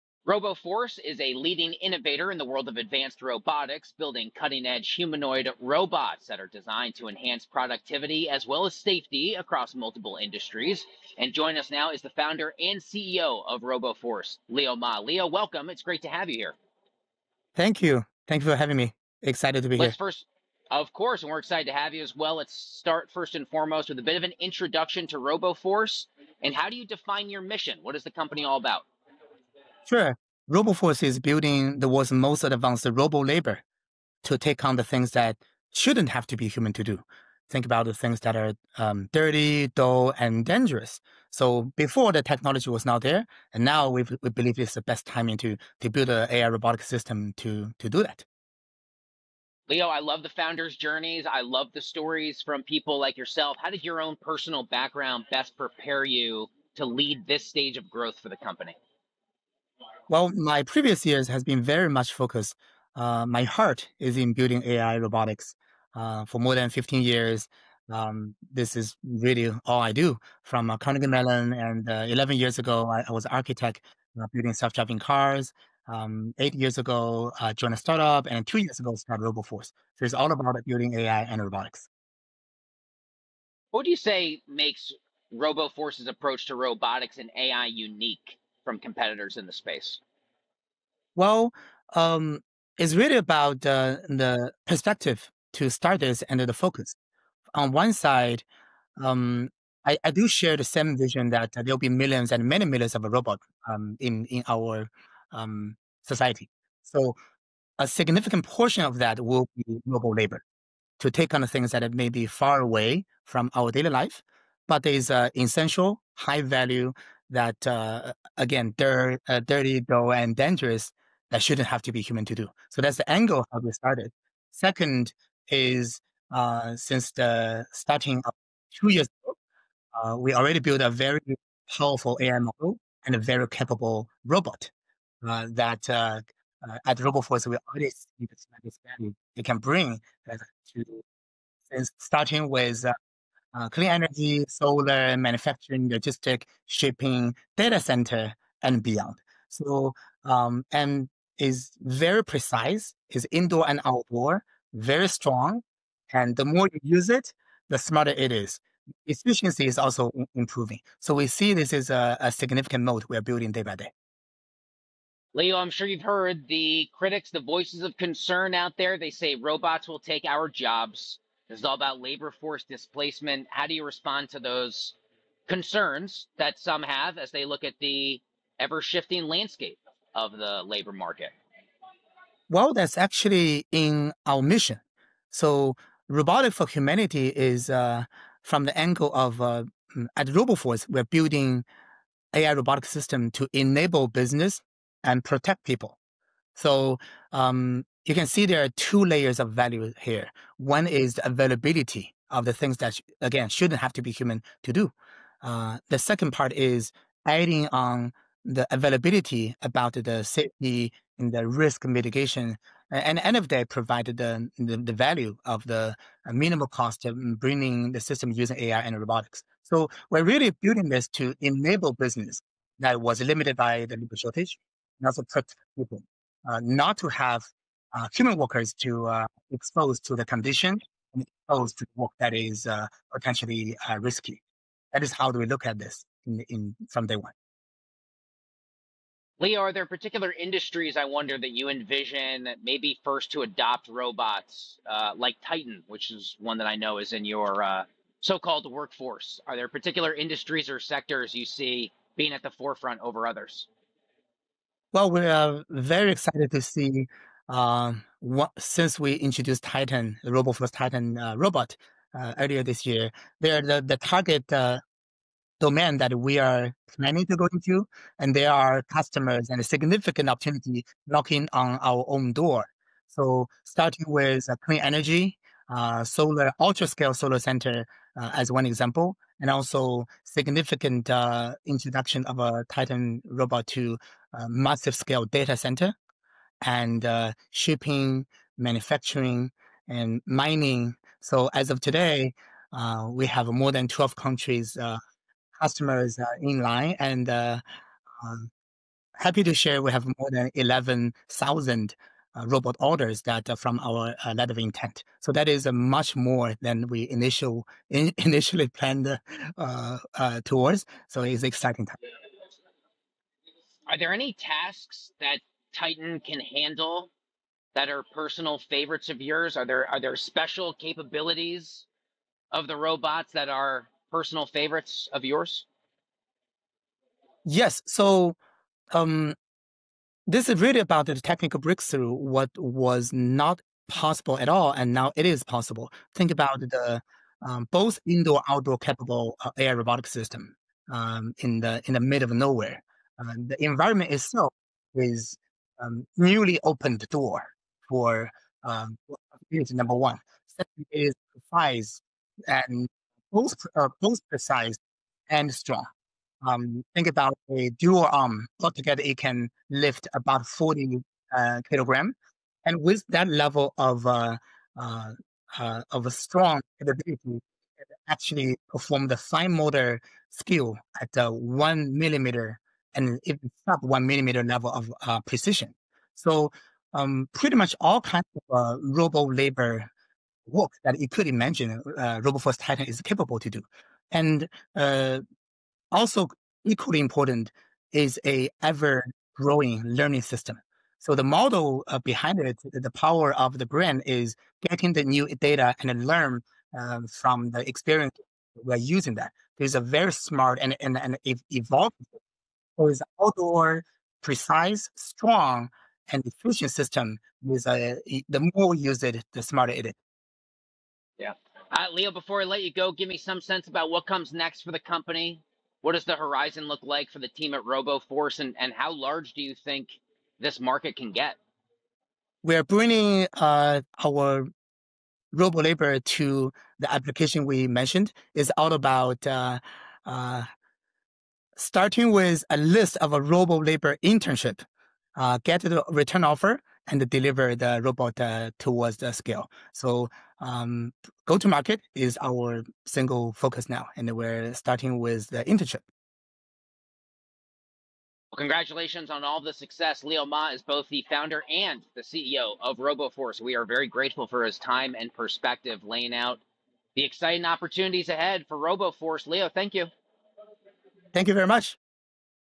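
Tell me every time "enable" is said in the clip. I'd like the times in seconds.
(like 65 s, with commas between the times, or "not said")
193 s, 221 s.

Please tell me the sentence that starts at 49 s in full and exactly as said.
Leo, I love the founders' journeys.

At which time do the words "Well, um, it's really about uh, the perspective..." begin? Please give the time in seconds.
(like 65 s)
91 s.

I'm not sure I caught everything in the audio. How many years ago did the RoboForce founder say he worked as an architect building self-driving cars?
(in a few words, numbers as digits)
11.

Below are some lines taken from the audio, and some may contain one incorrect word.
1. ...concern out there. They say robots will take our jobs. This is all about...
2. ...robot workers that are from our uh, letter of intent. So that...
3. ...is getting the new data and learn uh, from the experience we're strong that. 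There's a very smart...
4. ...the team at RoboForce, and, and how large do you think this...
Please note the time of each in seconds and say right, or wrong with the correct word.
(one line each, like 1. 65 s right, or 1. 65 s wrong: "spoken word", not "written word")
1. 167 s right
2. 302 s wrong: "orders", not "workers"
3. 394 s wrong: "using", not "strong"
4. 417 s right.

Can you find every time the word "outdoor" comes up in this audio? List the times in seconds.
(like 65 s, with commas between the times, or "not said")
153 s, 338 s, 403 s.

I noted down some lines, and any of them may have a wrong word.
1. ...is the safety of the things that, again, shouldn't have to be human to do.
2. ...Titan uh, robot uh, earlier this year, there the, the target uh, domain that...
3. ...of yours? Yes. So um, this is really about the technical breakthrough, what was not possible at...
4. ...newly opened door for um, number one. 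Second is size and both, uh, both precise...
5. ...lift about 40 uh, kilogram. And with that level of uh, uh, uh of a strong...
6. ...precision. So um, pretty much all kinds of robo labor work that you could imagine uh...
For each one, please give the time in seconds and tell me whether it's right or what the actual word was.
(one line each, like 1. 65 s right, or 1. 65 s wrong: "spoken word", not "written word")
1. 200 s wrong: "availability", not "safety"
2. 260 s right
3. 325 s right
4. 346 s right
5. 359 s right
6. 375 s right.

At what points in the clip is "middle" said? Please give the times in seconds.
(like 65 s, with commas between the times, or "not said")
341 s.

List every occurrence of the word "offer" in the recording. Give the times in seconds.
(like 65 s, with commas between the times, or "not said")
436 s.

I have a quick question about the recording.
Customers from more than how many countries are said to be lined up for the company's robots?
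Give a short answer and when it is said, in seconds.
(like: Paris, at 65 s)
12, at 293 s.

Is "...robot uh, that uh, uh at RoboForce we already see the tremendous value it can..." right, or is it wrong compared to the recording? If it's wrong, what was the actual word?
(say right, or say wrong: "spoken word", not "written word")
right.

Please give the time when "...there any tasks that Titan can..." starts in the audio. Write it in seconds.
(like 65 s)
313 s.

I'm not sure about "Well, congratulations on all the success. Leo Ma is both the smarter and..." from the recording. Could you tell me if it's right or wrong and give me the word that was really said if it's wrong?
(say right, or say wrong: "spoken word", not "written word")
wrong: "founder", not "smarter".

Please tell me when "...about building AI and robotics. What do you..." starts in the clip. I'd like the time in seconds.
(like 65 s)
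80 s.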